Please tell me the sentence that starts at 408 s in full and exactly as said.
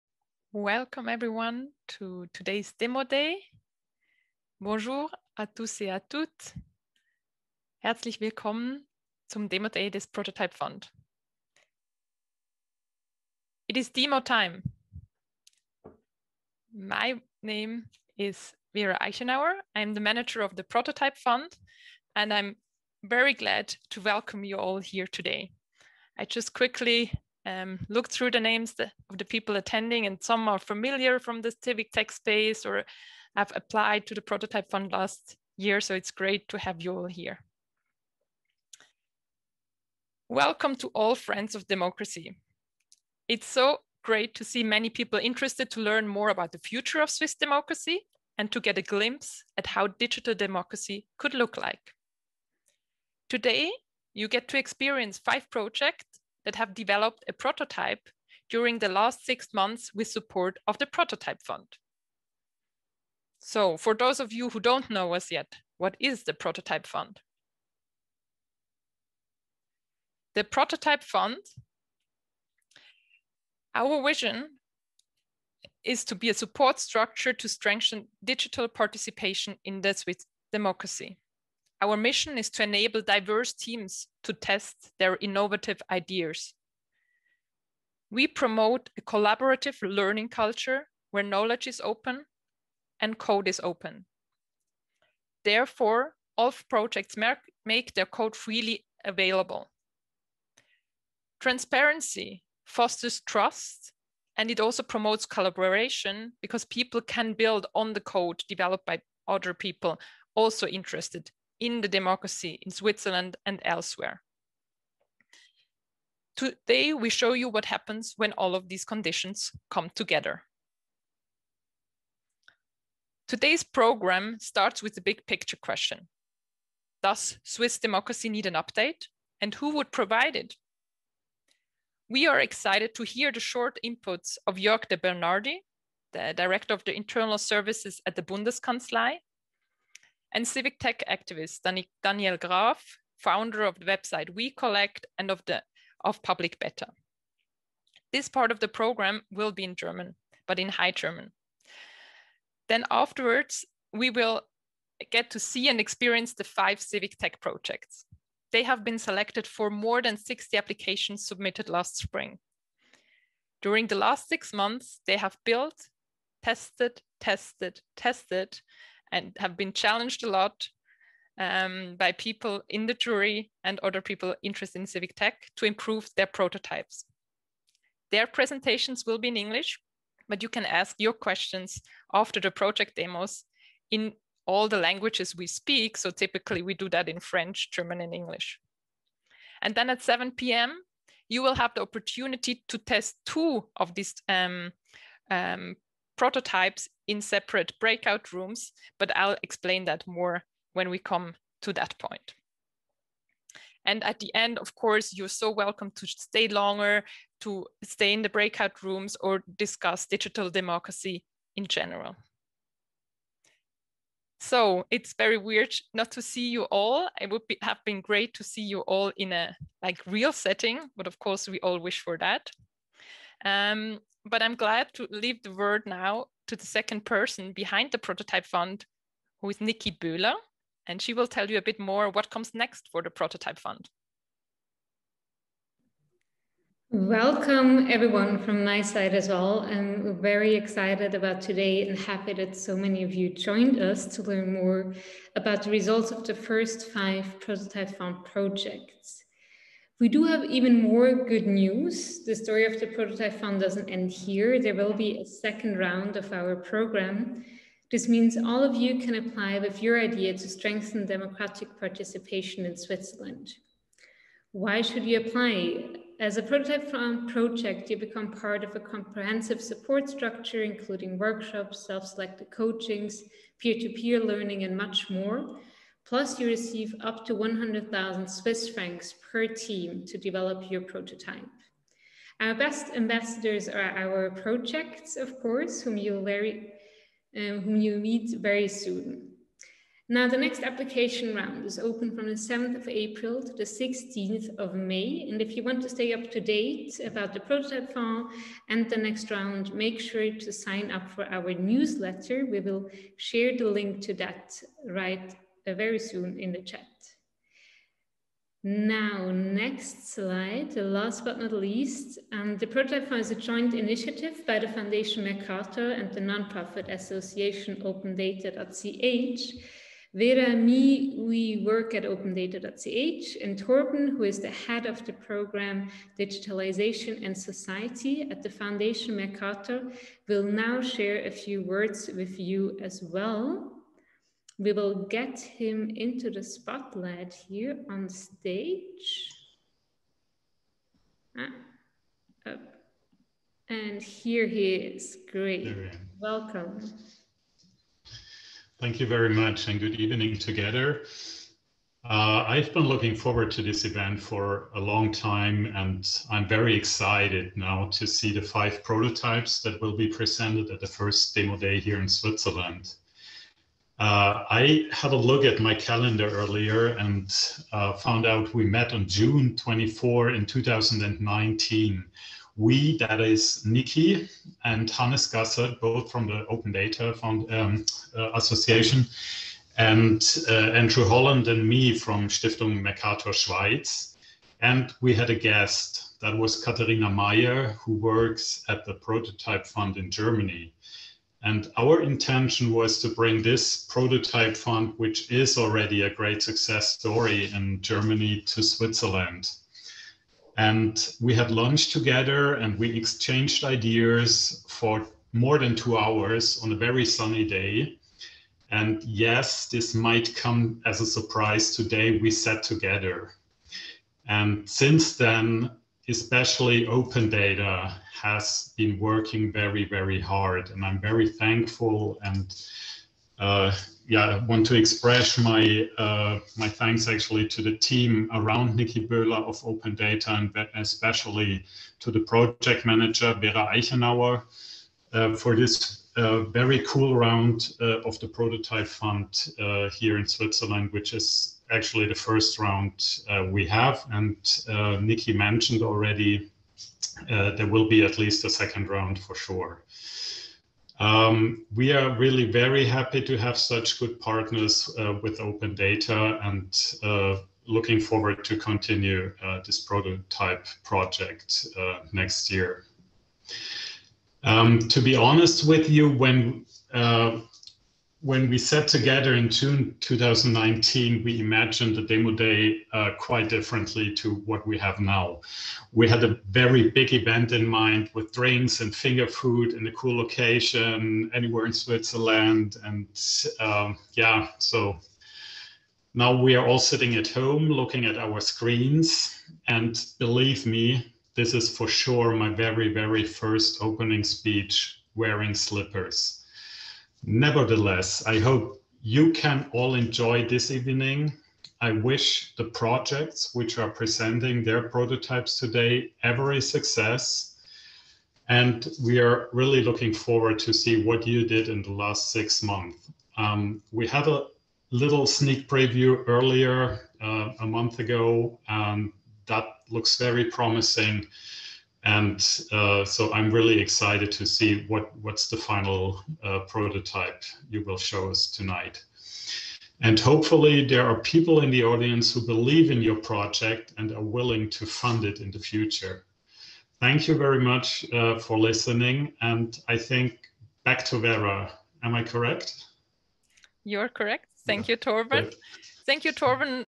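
And yes, this might come as a surprise today.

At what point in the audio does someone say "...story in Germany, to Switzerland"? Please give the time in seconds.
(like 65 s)
396 s.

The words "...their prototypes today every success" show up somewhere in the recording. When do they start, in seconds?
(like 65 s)
504 s.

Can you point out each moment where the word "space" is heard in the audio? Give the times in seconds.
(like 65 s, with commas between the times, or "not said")
32 s.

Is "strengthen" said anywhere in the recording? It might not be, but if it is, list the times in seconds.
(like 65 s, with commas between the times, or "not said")
77 s, 260 s.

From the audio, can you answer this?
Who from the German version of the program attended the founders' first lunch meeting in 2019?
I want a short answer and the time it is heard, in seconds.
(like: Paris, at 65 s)
Katharina Meyer, at 386 s.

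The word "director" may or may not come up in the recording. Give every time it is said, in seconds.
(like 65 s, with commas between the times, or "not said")
136 s.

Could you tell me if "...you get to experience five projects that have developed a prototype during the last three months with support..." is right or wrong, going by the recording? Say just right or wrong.
wrong.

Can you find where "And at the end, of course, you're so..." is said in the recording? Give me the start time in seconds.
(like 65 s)
203 s.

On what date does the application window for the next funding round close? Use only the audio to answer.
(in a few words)
16 May.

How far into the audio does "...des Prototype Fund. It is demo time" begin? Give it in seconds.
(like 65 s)
9 s.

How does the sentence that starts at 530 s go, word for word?
And hopefully there are people in the audience who believe in your project and are willing to fund it in the future.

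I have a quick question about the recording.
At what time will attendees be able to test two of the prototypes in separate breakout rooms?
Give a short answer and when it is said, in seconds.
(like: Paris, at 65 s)
7 p.m., at 190 s.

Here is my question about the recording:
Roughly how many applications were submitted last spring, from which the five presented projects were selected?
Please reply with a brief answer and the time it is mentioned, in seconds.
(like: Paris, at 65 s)
more than 60, at 159 s.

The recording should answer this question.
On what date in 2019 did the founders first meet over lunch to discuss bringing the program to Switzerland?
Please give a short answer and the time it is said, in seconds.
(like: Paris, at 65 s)
June 24, at 369 s.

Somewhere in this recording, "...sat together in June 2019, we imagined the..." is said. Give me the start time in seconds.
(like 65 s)
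468 s.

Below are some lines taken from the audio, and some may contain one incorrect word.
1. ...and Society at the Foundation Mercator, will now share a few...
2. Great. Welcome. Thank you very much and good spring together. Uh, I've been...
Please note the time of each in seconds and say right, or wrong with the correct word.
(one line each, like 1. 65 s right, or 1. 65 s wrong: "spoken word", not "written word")
1. 327 s right
2. 345 s wrong: "evening", not "spring".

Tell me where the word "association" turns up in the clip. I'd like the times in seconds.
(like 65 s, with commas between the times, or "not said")
316 s, 378 s.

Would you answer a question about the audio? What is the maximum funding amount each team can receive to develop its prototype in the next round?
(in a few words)
100,000 Swiss francs.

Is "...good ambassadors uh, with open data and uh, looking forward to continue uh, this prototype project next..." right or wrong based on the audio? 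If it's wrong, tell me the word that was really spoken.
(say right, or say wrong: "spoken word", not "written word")
wrong: "partners", not "ambassadors".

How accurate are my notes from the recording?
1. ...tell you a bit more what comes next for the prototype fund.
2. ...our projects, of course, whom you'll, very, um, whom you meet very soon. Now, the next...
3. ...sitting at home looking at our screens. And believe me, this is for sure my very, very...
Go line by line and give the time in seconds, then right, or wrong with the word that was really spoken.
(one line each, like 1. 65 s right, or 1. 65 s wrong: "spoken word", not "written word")
1. 231 s right
2. 283 s right
3. 486 s right.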